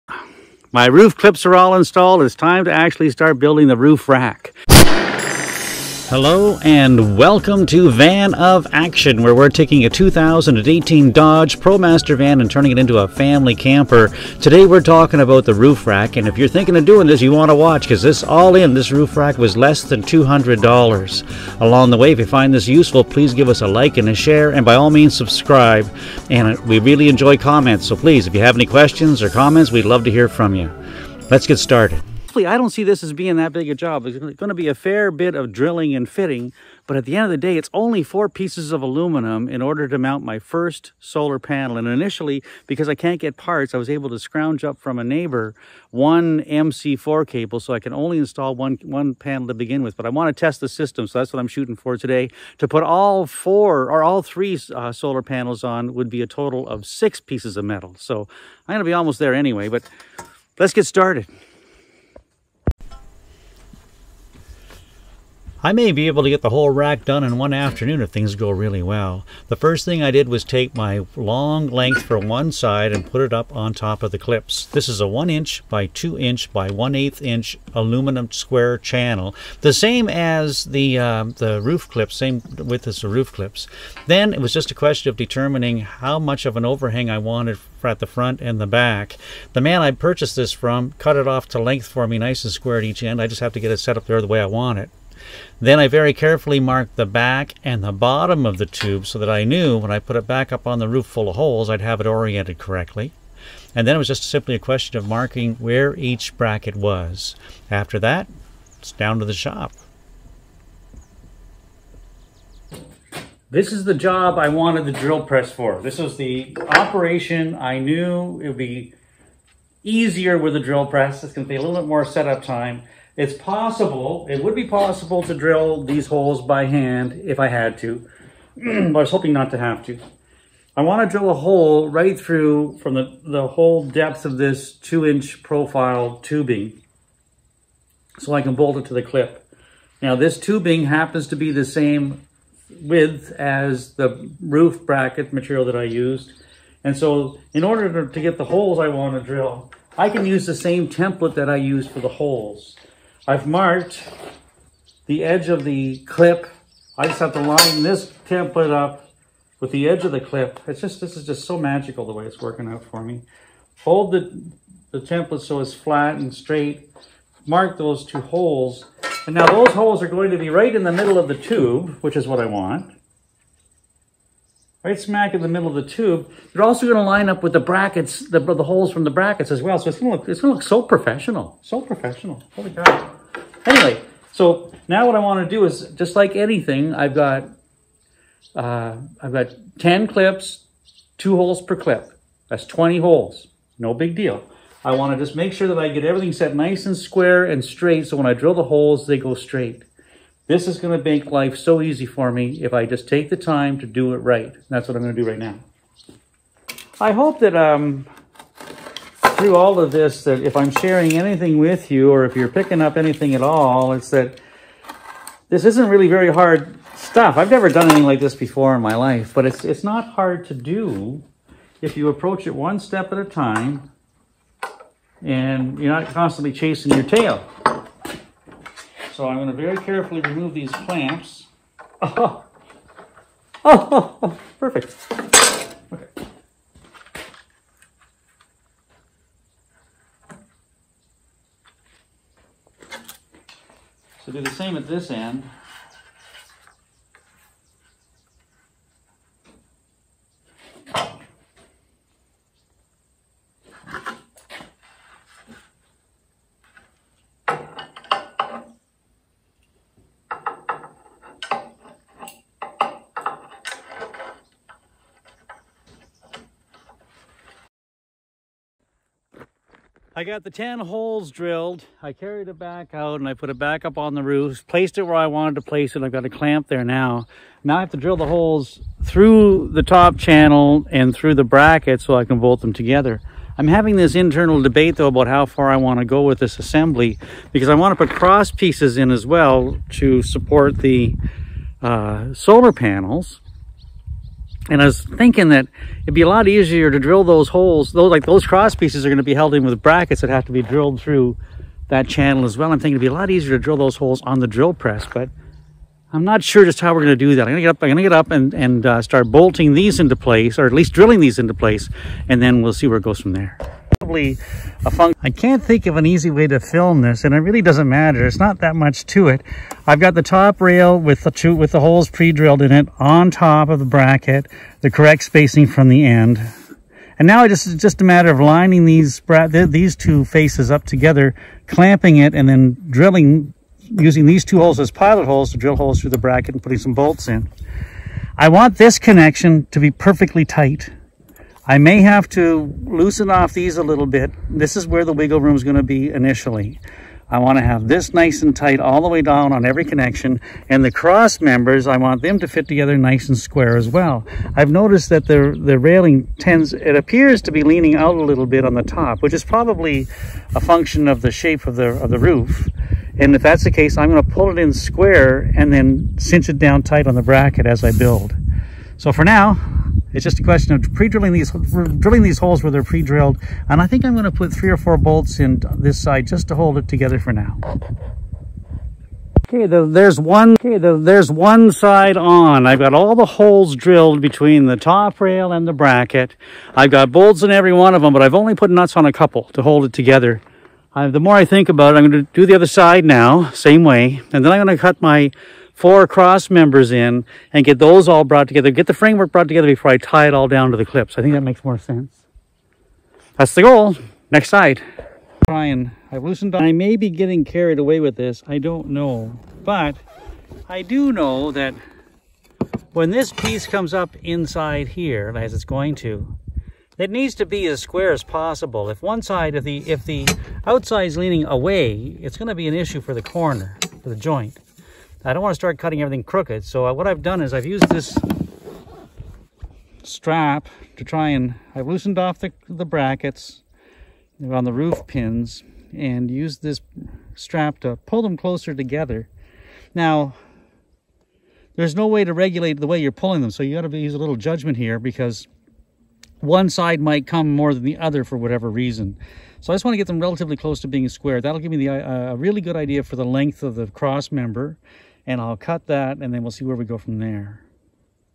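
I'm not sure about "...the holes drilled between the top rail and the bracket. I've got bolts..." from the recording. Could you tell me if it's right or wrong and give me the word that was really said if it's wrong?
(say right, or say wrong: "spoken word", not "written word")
right.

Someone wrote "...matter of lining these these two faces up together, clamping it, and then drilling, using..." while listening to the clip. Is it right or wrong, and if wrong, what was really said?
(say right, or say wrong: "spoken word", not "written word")
right.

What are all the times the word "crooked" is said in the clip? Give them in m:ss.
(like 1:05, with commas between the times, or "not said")
7:06.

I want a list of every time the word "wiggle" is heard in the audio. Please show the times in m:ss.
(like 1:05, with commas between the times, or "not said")
5:45.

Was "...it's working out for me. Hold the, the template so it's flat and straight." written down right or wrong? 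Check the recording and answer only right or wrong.
right.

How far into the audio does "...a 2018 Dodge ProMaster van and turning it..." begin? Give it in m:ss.
0:09.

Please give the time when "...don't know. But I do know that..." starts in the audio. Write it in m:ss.
6:48.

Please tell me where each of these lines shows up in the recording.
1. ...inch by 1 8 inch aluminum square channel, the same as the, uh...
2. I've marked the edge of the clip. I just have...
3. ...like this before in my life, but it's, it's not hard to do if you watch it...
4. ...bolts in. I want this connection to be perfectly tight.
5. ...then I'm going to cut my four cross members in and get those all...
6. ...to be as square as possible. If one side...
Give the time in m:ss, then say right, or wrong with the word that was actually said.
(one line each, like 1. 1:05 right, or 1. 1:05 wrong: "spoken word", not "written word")
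1. 1:16 right
2. 2:33 right
3. 3:38 wrong: "approach", not "watch"
4. 5:36 right
5. 6:34 right
6. 6:57 right.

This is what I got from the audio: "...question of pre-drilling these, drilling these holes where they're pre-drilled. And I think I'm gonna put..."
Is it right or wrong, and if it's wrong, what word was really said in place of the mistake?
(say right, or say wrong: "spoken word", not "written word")
right.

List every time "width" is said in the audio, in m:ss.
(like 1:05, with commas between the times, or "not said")
1:22, 2:22.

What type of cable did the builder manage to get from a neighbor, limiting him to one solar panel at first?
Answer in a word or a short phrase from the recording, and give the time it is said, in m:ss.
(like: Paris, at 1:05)
MC4 cable, at 0:46.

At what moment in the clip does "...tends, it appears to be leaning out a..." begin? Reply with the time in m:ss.
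5:56.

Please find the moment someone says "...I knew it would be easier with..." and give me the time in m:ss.
1:57.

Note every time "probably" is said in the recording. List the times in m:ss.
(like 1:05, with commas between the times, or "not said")
5:14, 5:59.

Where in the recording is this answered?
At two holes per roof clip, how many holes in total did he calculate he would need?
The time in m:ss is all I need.
3:12.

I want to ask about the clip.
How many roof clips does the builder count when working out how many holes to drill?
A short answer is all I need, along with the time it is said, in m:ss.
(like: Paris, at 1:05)
10, at 3:09.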